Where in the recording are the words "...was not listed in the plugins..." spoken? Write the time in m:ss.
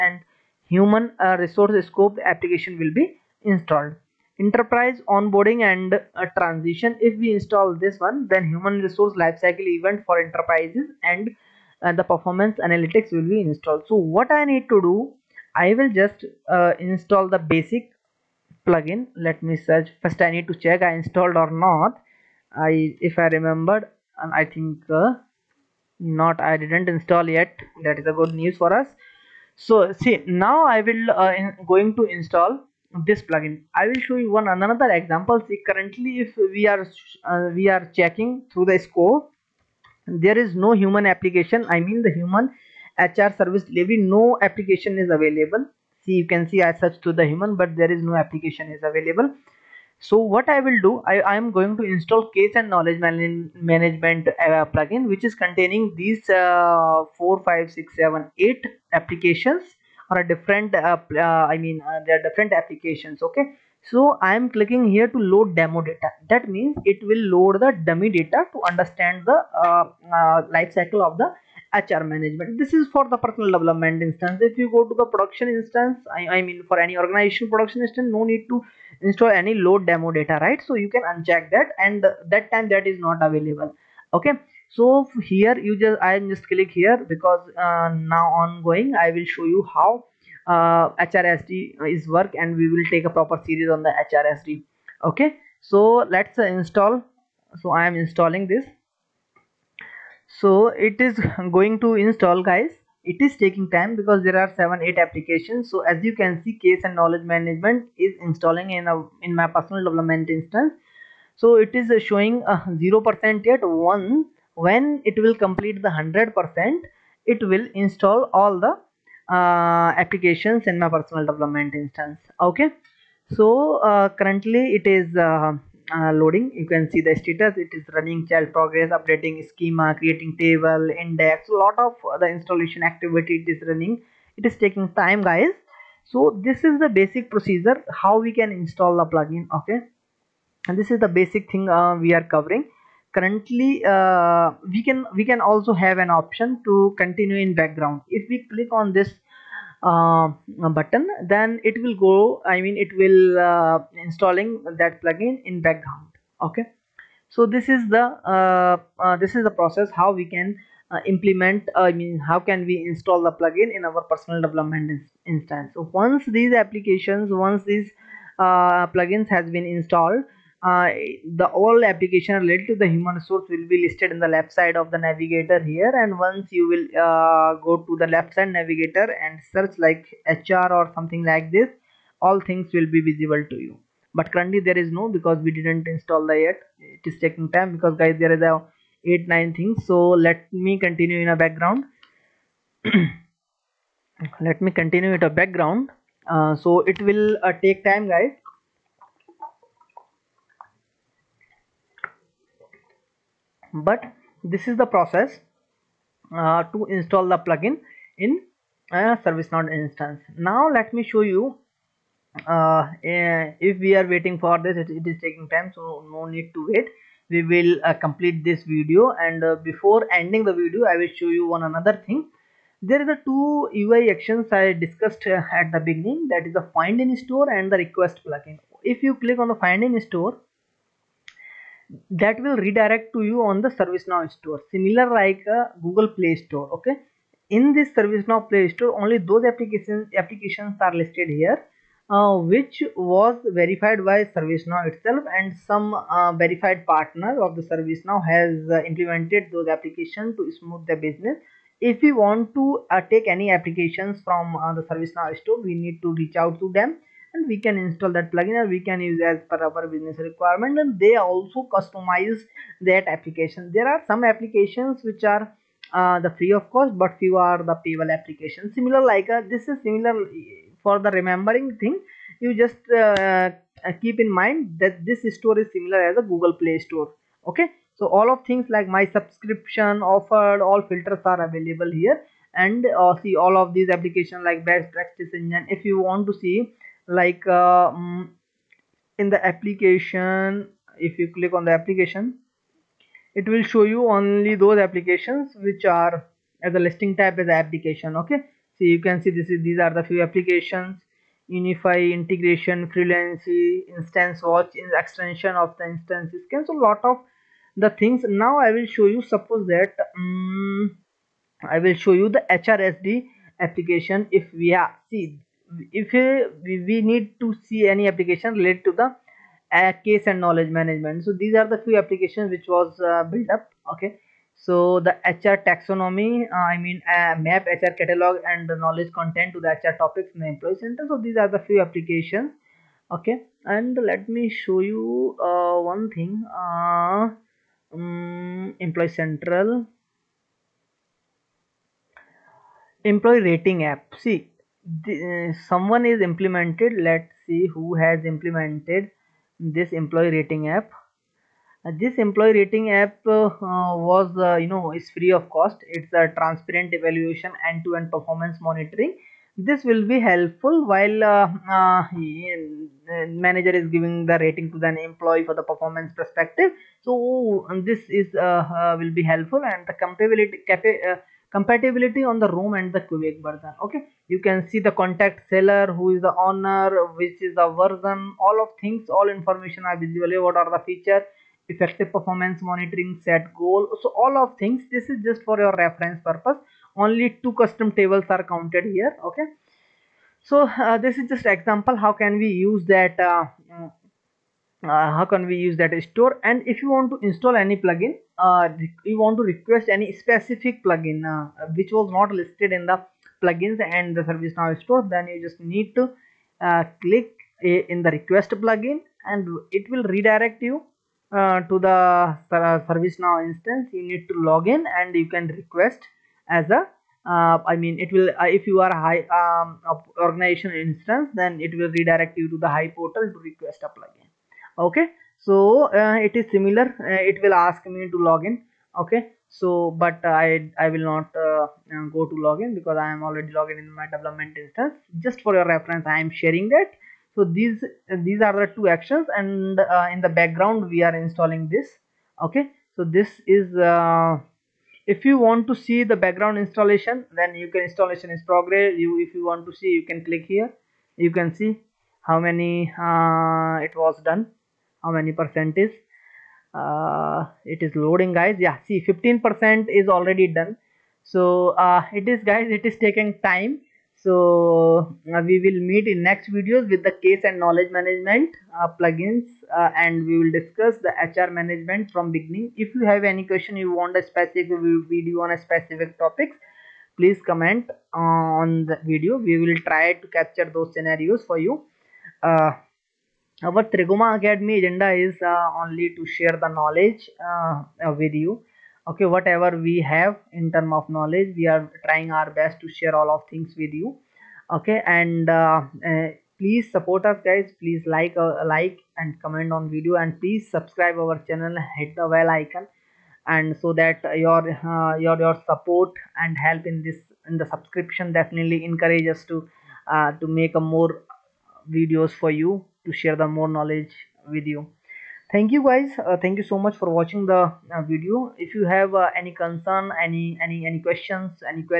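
6:41.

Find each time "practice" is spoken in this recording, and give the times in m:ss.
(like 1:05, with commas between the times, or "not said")
4:44.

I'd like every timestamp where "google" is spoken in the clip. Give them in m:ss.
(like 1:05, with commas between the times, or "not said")
3:55, 4:36.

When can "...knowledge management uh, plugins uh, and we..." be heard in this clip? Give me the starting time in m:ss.
7:47.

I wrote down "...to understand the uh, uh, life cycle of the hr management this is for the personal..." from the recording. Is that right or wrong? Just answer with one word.
right.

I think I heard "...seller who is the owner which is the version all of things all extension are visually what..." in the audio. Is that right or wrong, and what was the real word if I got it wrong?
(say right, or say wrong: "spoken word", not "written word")
wrong: "information", not "extension".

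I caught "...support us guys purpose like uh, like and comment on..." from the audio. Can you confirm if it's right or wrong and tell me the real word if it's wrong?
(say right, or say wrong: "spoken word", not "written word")
wrong: "please", not "purpose".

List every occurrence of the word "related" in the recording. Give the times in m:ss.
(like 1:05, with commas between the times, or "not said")
2:52, 5:18.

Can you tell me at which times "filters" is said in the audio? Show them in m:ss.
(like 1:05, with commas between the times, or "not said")
4:40.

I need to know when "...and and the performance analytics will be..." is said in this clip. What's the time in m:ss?
0:11.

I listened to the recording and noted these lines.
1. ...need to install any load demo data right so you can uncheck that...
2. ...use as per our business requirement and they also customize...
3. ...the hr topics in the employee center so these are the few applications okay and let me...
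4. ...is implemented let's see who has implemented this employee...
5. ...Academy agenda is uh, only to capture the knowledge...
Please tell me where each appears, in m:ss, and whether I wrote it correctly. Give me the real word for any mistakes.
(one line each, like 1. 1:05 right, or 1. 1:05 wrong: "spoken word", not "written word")
1. 1:18 right
2. 4:19 right
3. 5:29 right
4. 5:46 right
5. 8:04 wrong: "share", not "capture".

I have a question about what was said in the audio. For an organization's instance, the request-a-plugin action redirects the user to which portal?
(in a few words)
HI portal.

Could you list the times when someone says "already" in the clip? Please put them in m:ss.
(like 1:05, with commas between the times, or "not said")
7:13, 7:40.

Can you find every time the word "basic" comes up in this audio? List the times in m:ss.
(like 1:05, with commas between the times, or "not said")
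0:17, 2:17, 2:21.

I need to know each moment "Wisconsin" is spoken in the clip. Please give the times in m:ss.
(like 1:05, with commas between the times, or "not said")
not said.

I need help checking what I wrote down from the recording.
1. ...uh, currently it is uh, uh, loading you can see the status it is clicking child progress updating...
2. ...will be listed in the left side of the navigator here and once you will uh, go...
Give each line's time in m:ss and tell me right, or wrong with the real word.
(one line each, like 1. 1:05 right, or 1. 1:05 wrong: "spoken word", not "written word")
1. 2:03 wrong: "running", not "clicking"
2. 2:53 right.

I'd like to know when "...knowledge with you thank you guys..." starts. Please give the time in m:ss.
8:33.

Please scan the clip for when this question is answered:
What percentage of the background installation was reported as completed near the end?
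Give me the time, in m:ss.
7:39.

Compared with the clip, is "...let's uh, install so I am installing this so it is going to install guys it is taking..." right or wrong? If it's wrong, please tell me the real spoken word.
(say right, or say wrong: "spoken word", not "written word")
right.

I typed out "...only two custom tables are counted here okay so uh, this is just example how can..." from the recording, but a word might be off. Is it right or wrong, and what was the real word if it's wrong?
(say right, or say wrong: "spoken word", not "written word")
right.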